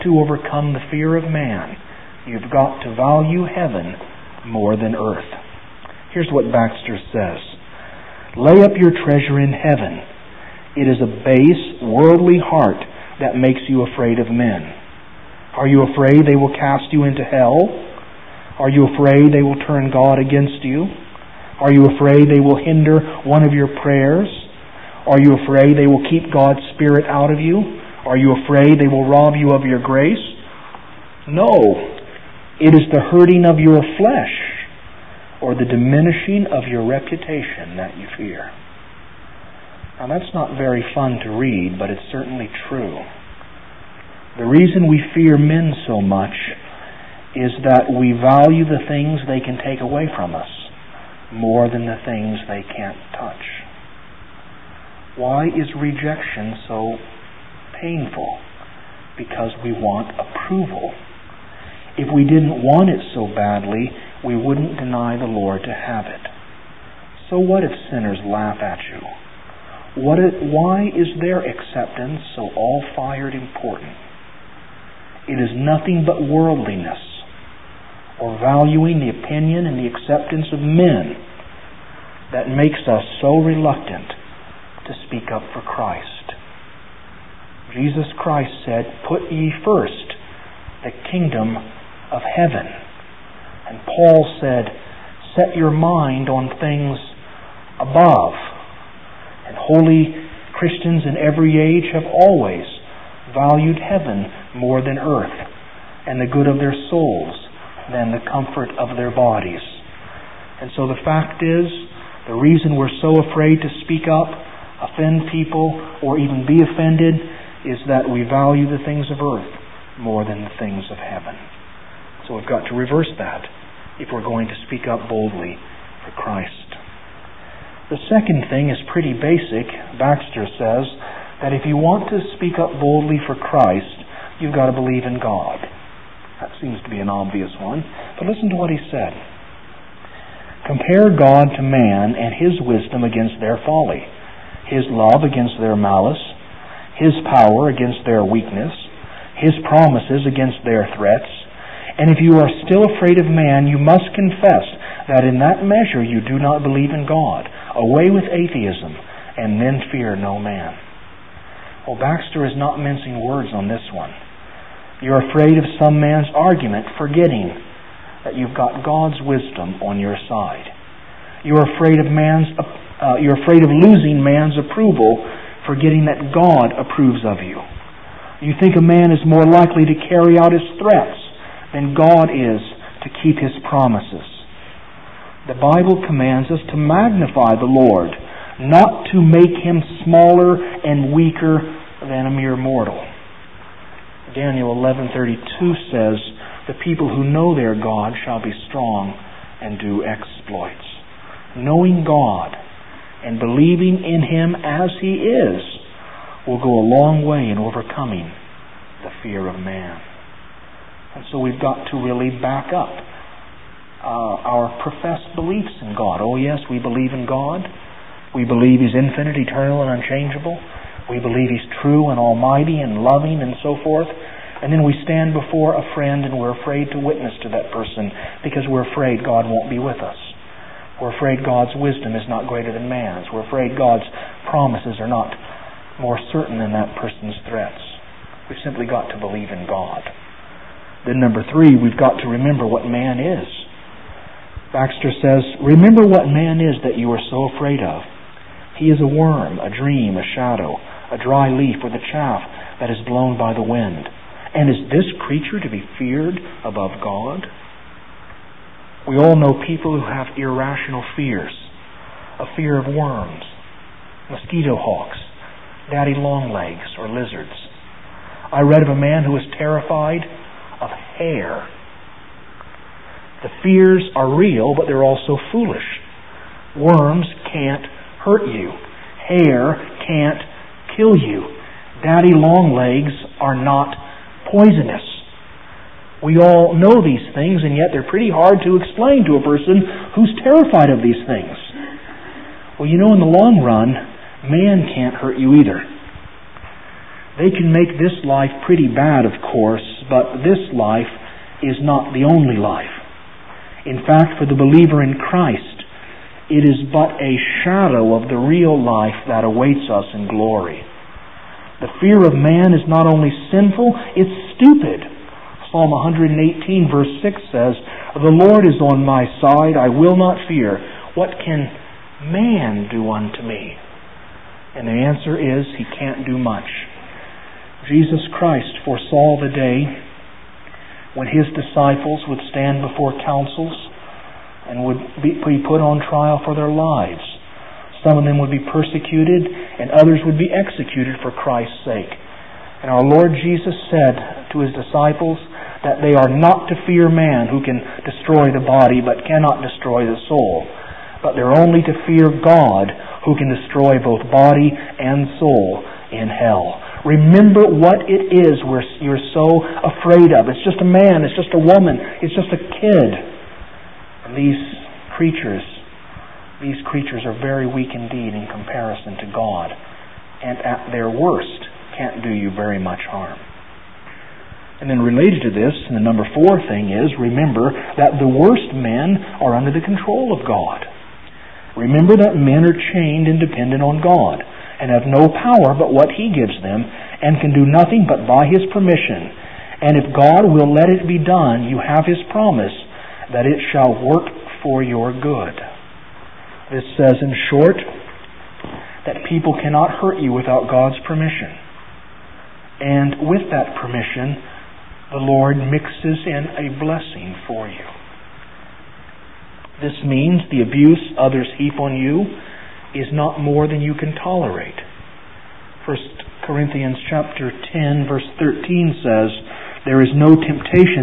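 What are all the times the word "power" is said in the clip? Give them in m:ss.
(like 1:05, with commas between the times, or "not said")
2:27, 6:25.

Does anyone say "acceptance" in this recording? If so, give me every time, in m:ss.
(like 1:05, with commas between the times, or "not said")
1:11, 1:19.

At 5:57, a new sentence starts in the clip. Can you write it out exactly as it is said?
Remember what it is we're, you're so afraid of.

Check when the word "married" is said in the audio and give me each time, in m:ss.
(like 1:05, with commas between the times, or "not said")
not said.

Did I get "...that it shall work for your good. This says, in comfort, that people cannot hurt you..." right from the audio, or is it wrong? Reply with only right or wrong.
wrong.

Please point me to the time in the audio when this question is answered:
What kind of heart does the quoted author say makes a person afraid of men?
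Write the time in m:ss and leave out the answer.
0:11.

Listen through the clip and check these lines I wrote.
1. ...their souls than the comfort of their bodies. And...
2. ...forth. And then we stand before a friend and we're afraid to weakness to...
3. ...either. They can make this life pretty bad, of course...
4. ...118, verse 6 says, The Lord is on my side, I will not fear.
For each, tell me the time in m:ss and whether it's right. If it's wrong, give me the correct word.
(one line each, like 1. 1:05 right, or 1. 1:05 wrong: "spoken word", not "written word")
1. 1:46 right
2. 3:43 wrong: "witness", not "weakness"
3. 4:55 right
4. 5:15 right.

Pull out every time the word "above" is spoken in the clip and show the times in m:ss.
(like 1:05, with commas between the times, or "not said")
1:37, 4:16.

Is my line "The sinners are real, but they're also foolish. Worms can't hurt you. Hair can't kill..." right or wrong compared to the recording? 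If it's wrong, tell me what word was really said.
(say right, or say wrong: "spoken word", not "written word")
wrong: "fears", not "sinners".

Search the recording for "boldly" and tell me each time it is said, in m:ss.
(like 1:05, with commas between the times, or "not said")
2:05, 2:12.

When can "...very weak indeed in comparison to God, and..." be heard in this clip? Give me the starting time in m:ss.
6:07.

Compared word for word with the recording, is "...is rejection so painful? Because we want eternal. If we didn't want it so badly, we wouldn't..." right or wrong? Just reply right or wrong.
wrong.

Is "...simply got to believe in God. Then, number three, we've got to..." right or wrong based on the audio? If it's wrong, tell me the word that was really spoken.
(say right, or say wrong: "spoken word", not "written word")
right.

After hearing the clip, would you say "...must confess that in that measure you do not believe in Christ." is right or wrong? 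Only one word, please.
wrong.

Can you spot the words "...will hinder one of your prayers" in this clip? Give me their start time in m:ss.
0:22.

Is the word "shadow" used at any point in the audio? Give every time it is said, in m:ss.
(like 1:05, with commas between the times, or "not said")
4:10, 5:07.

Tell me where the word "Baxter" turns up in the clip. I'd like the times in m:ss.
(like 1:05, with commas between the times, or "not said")
0:06, 2:09, 2:41, 4:04.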